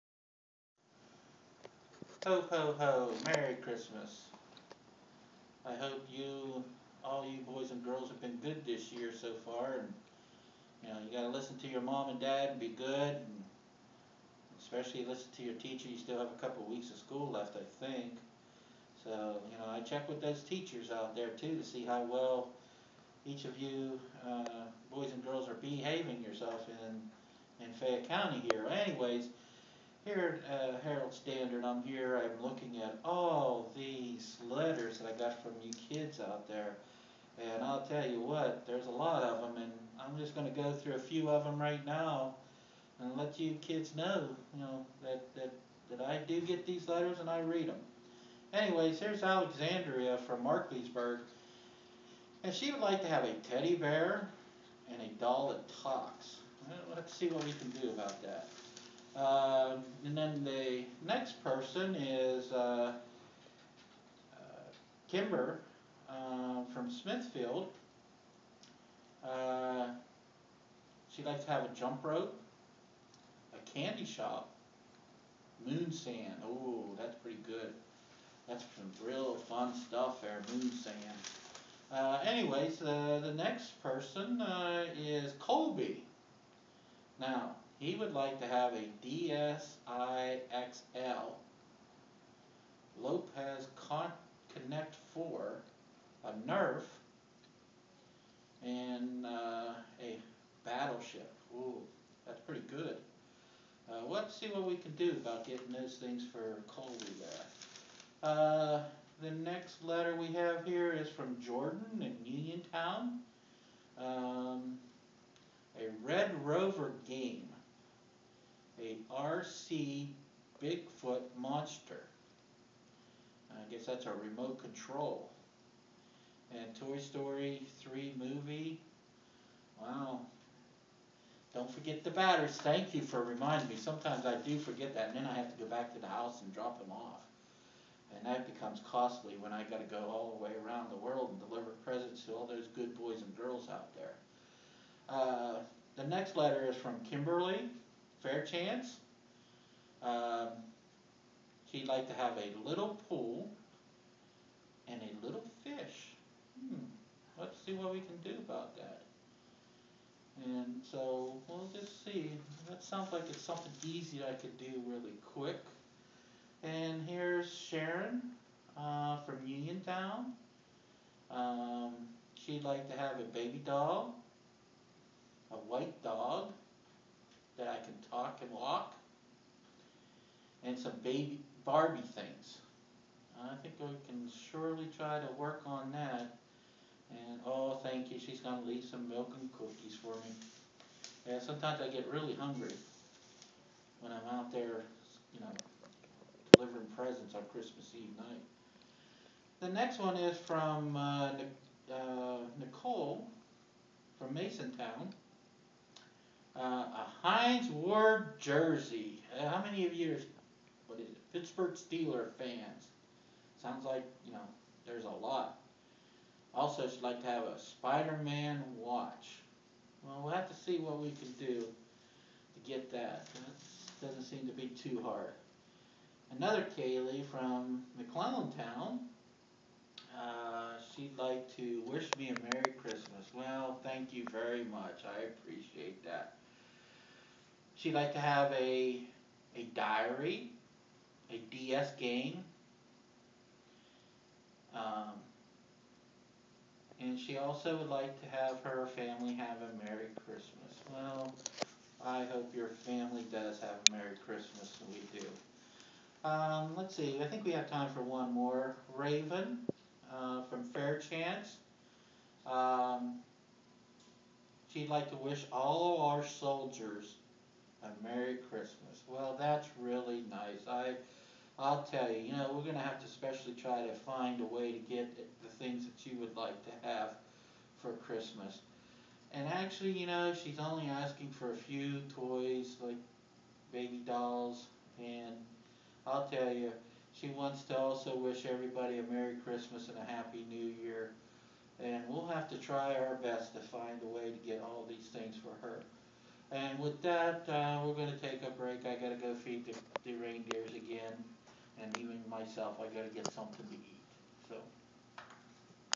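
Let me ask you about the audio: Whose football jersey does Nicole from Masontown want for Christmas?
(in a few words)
Hines Ward.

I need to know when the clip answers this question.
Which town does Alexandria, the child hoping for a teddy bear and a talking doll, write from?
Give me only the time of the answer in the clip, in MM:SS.
00:50.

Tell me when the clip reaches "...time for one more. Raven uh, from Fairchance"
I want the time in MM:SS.
04:17.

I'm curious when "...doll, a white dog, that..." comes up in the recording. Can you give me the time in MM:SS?
02:53.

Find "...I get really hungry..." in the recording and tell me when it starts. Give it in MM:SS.
03:11.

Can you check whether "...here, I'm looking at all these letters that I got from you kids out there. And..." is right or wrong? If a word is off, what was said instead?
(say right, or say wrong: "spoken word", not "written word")
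right.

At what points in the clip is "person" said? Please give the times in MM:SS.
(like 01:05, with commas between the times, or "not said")
01:01, 01:23.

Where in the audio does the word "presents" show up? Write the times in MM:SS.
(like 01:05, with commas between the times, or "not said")
02:21, 03:16.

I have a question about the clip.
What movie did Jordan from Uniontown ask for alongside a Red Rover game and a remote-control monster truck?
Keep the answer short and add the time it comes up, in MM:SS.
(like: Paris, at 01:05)
Toy Story 3, at 02:06.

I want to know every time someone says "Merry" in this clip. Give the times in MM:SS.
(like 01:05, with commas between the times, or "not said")
00:03, 03:52, 04:09, 04:13, 04:49.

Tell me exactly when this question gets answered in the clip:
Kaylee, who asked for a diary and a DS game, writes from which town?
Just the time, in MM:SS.
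03:47.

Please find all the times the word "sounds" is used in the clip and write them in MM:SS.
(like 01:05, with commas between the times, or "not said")
02:42, 03:33.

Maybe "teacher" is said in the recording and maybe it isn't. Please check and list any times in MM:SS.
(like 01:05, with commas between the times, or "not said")
00:15, 00:20.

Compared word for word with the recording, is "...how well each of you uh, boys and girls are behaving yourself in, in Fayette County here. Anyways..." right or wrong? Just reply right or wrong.
right.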